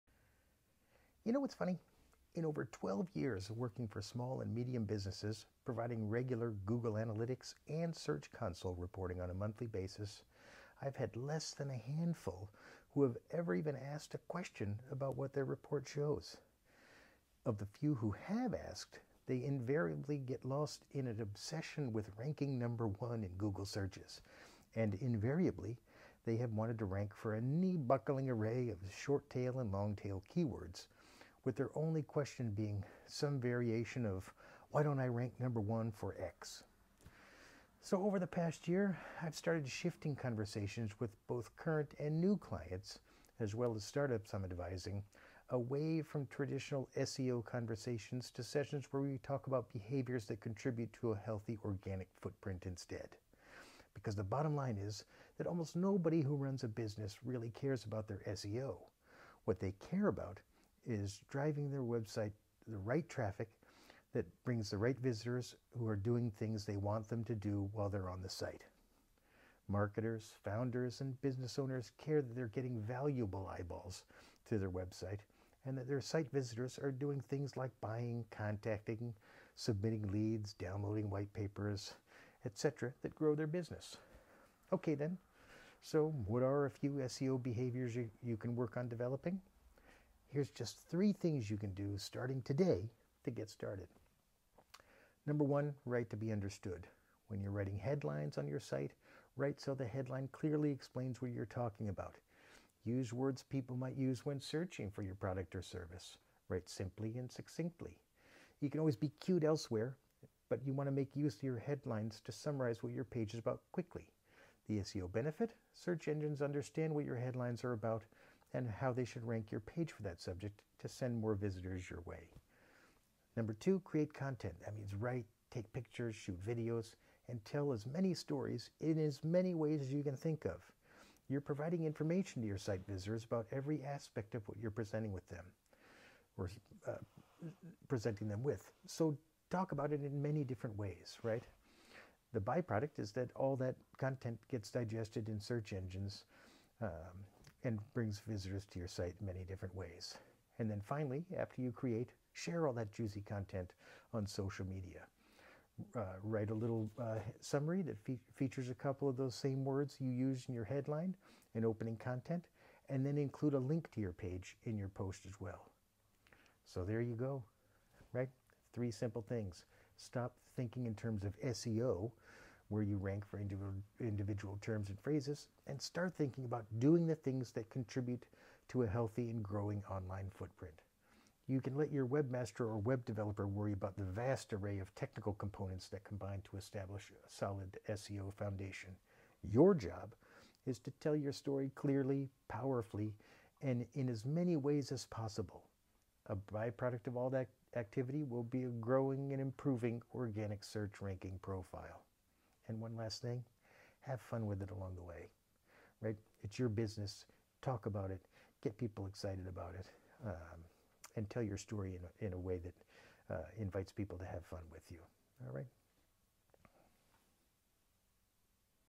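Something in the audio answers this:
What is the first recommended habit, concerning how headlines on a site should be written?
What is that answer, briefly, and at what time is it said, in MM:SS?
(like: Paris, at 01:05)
Write to be understood, at 01:35.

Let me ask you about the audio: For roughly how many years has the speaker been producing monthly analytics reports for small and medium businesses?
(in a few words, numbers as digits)
12.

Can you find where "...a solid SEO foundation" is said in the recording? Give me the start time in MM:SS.
03:07.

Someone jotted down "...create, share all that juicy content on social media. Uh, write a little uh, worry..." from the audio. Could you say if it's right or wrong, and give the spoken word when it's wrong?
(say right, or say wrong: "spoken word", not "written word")
wrong: "summary", not "worry".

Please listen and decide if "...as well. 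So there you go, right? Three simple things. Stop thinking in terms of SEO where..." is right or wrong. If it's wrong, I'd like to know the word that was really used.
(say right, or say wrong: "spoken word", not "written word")
right.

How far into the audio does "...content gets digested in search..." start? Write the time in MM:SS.
02:23.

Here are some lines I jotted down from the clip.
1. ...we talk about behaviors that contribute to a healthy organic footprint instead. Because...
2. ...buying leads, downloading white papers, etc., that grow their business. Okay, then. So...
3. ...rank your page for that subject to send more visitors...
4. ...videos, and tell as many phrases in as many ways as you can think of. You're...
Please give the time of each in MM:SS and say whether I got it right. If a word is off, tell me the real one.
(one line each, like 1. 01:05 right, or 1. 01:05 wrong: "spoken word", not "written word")
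1. 00:49 right
2. 01:19 wrong: "submitting", not "buying"
3. 01:59 right
4. 02:06 wrong: "stories", not "phrases".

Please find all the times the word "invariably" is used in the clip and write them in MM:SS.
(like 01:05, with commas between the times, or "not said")
00:19, 00:24.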